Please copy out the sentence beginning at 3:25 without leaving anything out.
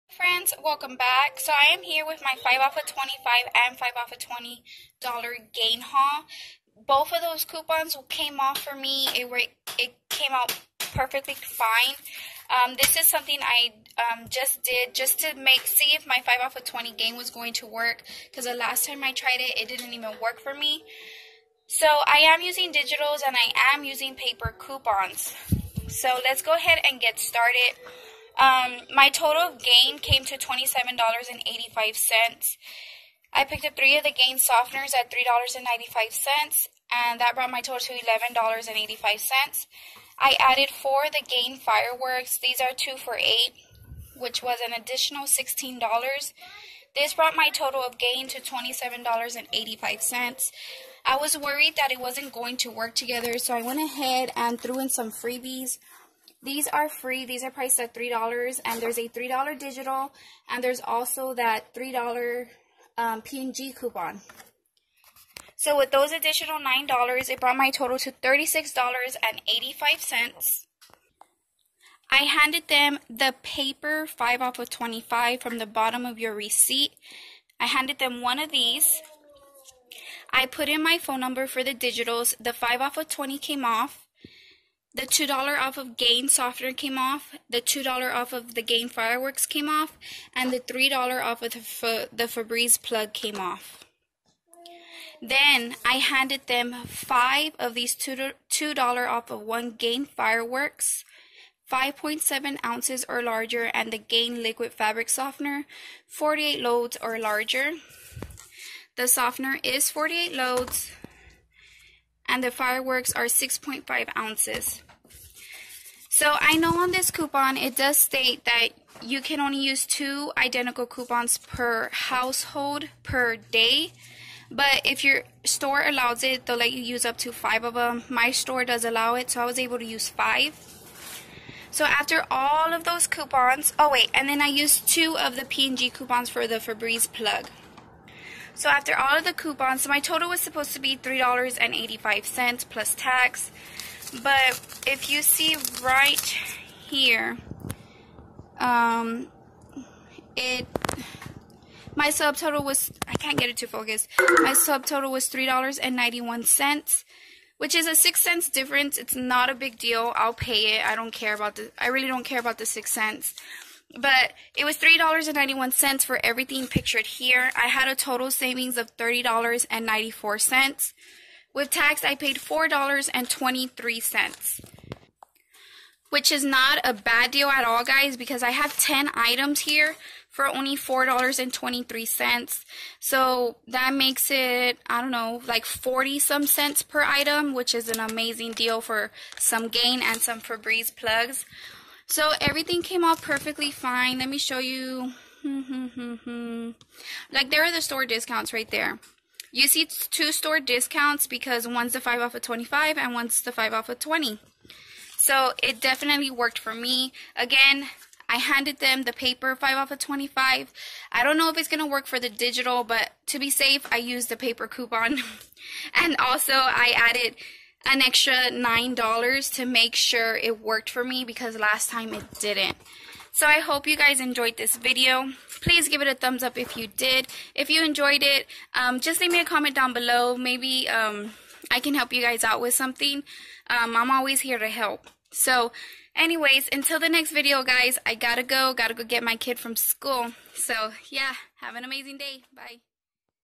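So it definitely worked for me.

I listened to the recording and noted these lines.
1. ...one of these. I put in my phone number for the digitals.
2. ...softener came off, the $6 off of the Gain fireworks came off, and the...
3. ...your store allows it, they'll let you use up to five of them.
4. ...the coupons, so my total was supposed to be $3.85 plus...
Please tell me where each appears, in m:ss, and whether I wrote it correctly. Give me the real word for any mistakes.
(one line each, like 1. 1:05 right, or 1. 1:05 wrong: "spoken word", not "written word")
1. 1:18 right
2. 1:26 wrong: "2", not "6"
3. 2:05 right
4. 2:19 right.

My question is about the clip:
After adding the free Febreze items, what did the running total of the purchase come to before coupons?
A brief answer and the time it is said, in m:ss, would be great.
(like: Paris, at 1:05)
$36.85, at 1:08.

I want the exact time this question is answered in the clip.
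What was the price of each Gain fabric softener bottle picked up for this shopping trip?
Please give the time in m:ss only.
0:35.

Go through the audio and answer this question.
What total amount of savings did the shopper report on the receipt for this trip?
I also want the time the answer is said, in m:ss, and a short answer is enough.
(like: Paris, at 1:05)
$30.94, at 2:48.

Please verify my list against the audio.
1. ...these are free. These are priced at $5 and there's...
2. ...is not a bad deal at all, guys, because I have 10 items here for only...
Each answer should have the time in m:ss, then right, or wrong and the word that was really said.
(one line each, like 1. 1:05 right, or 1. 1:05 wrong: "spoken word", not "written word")
1. 0:56 wrong: "3", not "5"
2. 2:56 right.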